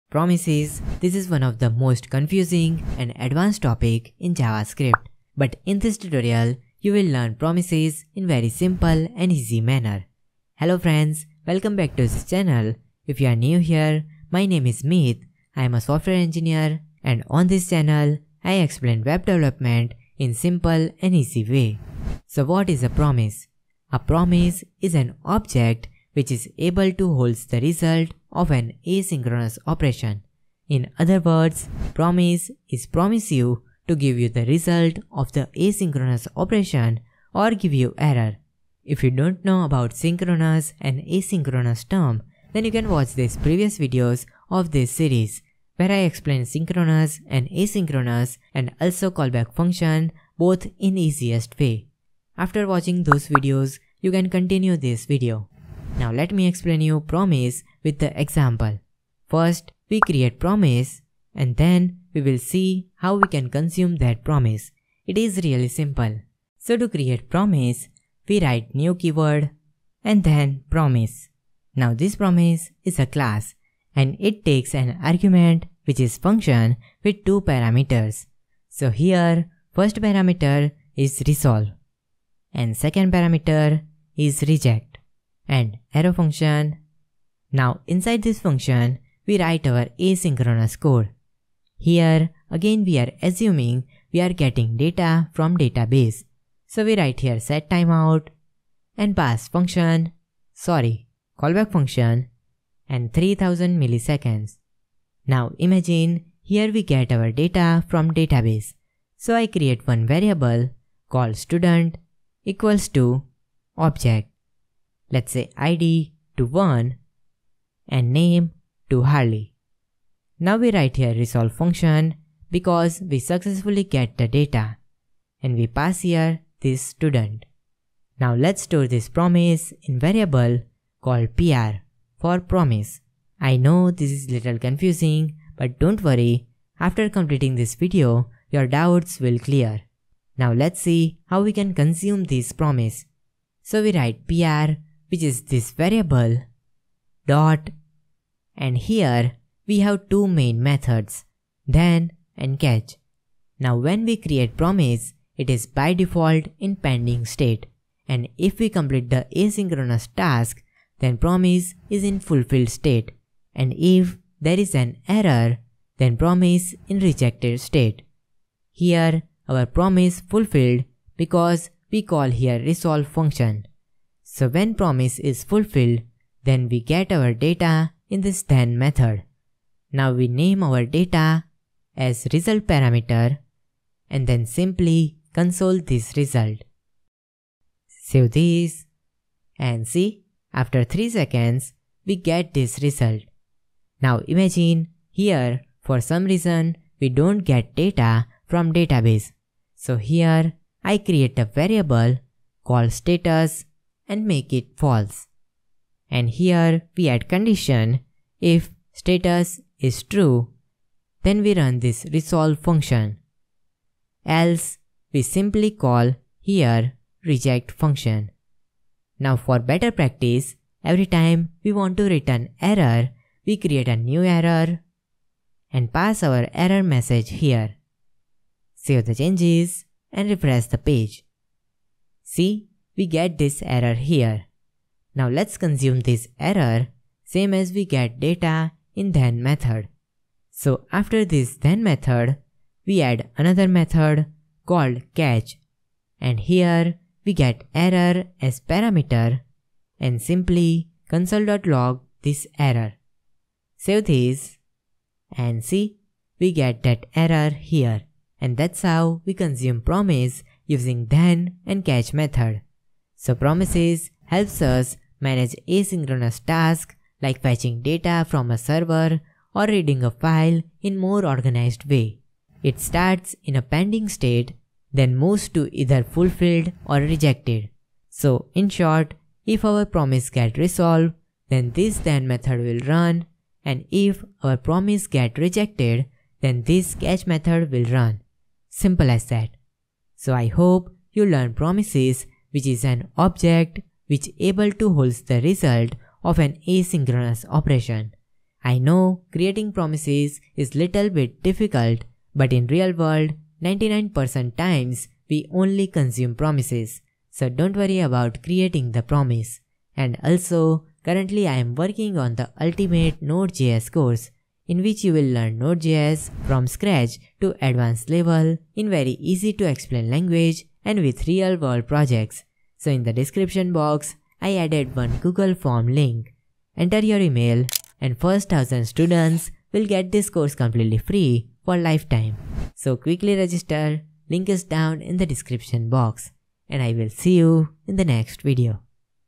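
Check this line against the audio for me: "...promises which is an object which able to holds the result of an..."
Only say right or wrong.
right.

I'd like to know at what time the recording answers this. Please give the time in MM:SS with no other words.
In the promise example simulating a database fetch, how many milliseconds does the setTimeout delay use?
01:43.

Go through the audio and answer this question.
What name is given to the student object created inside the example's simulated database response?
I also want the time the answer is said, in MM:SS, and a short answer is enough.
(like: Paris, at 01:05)
Harley, at 01:59.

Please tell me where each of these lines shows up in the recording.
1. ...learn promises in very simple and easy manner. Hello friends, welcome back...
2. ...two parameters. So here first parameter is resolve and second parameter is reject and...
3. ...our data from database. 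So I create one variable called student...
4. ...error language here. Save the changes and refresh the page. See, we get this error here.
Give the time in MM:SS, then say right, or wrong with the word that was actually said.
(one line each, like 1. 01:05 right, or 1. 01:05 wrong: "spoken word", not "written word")
1. 00:07 right
2. 01:17 right
3. 01:47 right
4. 03:46 wrong: "message", not "language".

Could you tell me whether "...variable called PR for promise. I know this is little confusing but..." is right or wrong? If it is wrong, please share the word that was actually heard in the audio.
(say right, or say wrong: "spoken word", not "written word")
right.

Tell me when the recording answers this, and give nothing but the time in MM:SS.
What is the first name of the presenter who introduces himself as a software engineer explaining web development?
00:14.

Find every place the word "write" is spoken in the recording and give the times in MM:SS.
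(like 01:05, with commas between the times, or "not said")
01:08, 01:29, 01:36, 02:00, 02:23.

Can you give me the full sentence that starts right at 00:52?
After watching those videos, you can continue this video.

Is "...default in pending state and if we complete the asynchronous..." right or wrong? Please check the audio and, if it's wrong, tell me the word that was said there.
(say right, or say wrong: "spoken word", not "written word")
right.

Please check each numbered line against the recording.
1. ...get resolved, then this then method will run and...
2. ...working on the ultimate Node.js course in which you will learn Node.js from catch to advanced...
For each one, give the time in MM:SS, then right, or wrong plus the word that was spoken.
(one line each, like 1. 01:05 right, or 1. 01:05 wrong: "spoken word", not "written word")
1. 04:40 right
2. 05:11 wrong: "scratch", not "catch".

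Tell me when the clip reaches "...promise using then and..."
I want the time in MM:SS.
04:19.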